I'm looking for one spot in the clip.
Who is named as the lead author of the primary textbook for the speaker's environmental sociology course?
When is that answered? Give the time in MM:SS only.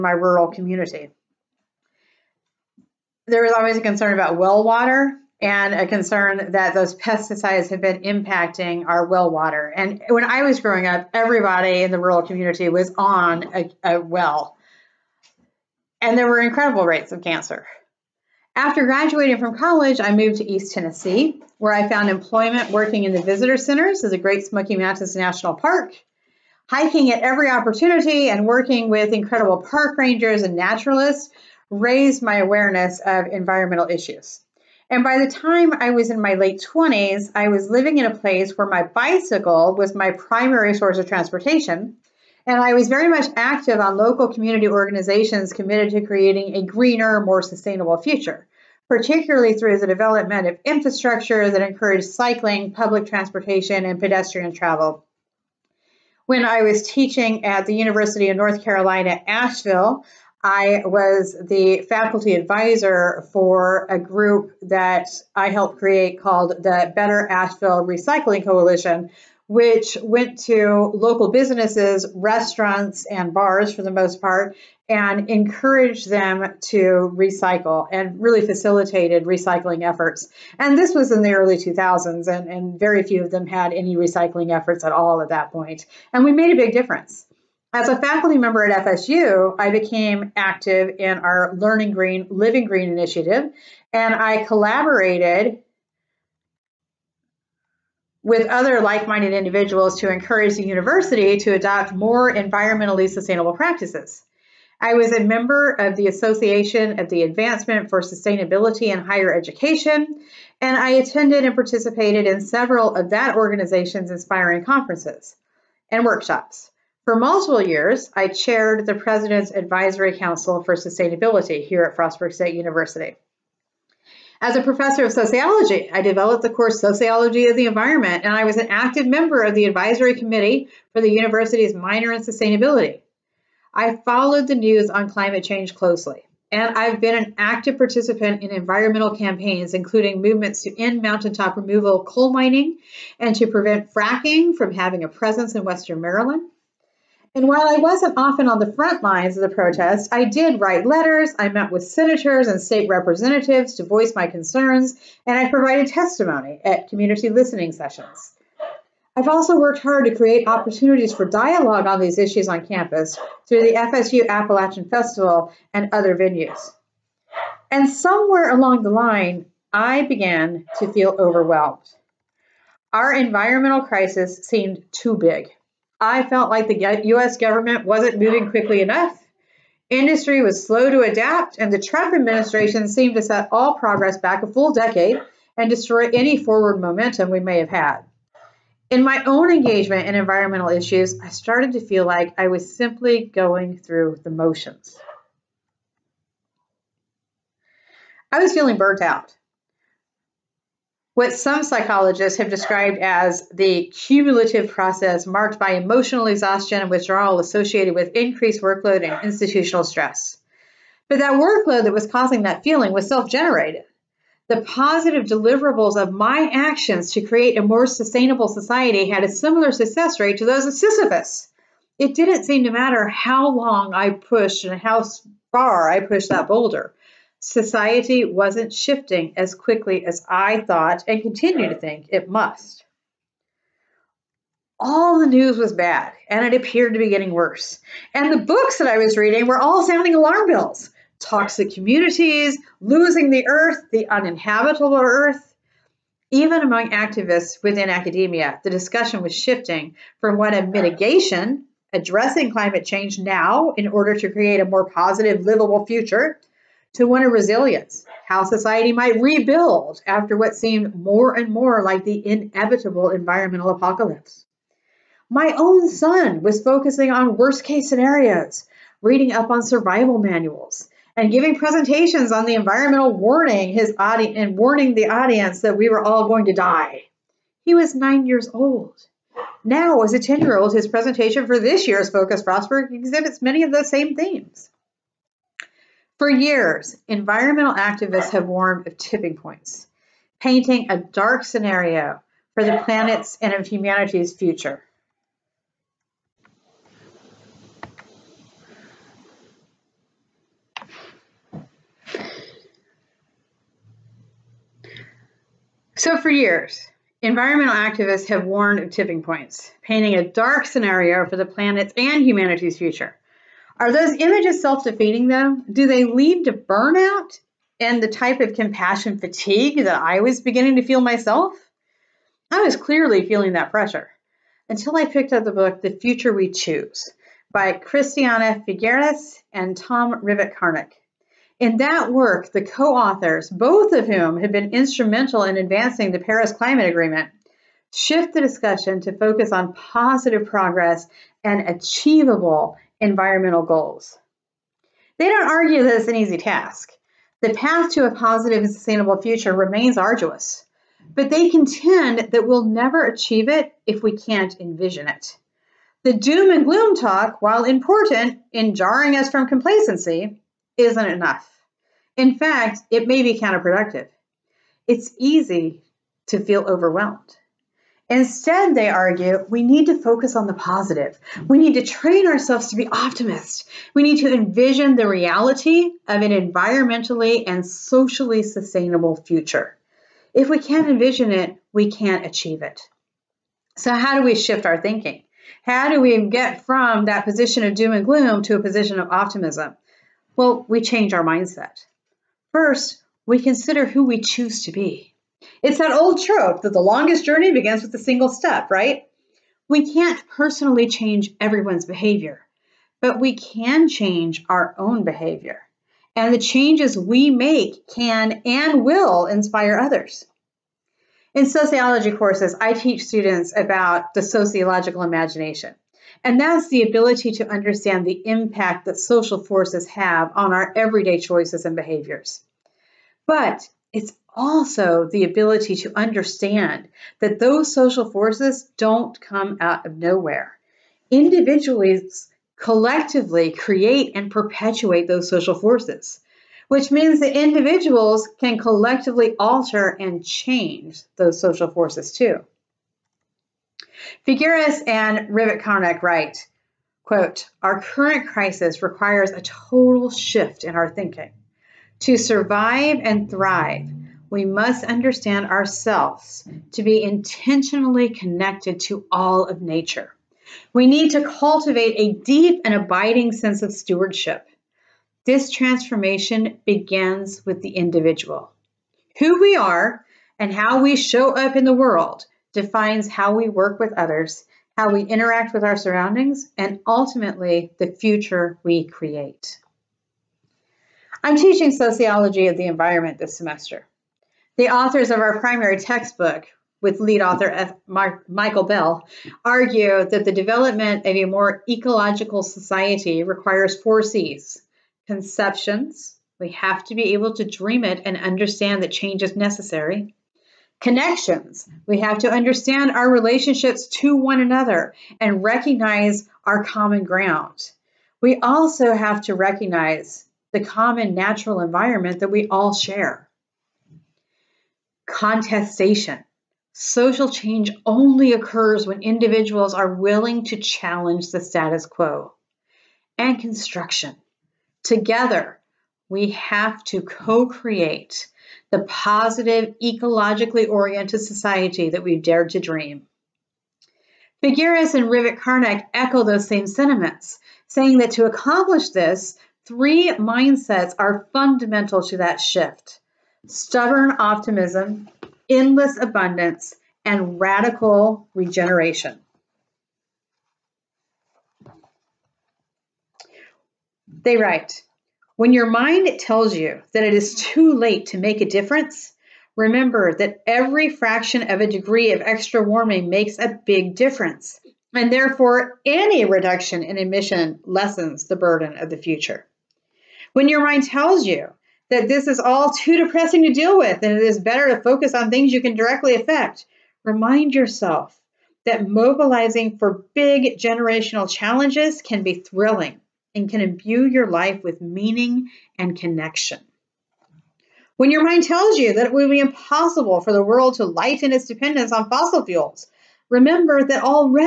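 08:08.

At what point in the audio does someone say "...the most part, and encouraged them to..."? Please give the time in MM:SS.
01:13.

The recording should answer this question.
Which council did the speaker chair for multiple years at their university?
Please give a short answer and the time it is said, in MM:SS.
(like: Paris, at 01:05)
President's Advisory Council for Sustainability, at 01:58.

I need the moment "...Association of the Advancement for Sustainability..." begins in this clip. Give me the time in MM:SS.
01:46.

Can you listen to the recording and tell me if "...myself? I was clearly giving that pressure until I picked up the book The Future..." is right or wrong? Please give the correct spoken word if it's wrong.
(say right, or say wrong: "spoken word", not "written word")
wrong: "feeling", not "giving".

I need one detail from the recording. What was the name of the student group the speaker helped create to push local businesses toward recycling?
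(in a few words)
Better Asheville Recycling Coalition.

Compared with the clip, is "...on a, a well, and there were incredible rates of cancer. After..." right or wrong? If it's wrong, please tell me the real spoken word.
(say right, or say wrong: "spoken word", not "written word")
right.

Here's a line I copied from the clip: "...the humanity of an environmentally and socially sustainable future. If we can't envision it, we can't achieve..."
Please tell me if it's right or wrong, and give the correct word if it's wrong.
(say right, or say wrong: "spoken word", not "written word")
wrong: "reality", not "humanity".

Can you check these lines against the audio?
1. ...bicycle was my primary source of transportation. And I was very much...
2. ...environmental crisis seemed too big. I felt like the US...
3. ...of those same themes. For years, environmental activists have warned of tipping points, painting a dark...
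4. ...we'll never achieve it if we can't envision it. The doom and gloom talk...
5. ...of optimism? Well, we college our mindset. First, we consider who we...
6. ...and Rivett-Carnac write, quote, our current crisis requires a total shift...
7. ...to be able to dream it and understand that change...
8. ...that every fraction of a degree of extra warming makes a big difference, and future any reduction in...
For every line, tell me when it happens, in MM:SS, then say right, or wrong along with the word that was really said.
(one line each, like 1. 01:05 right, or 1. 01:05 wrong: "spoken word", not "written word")
1. 00:38 right
2. 02:53 right
3. 04:43 right
4. 05:52 right
5. 06:28 wrong: "change", not "college"
6. 07:24 right
7. 08:16 right
8. 09:20 wrong: "therefore", not "future".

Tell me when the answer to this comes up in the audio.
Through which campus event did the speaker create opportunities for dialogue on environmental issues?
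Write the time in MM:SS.
02:43.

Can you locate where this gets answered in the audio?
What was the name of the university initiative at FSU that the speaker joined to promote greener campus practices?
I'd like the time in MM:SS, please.
01:31.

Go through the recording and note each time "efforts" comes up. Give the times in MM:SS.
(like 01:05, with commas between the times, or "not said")
01:19, 01:24.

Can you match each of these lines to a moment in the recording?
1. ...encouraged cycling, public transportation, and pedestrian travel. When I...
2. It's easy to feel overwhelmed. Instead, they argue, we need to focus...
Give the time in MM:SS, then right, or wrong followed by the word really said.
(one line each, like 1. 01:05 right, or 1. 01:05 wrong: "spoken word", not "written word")
1. 00:51 right
2. 06:04 right.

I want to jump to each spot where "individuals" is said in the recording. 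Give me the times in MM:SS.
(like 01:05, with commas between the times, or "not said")
01:39, 07:11, 07:17, 07:47, 08:39.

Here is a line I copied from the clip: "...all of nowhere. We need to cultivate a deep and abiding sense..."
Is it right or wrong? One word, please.
wrong.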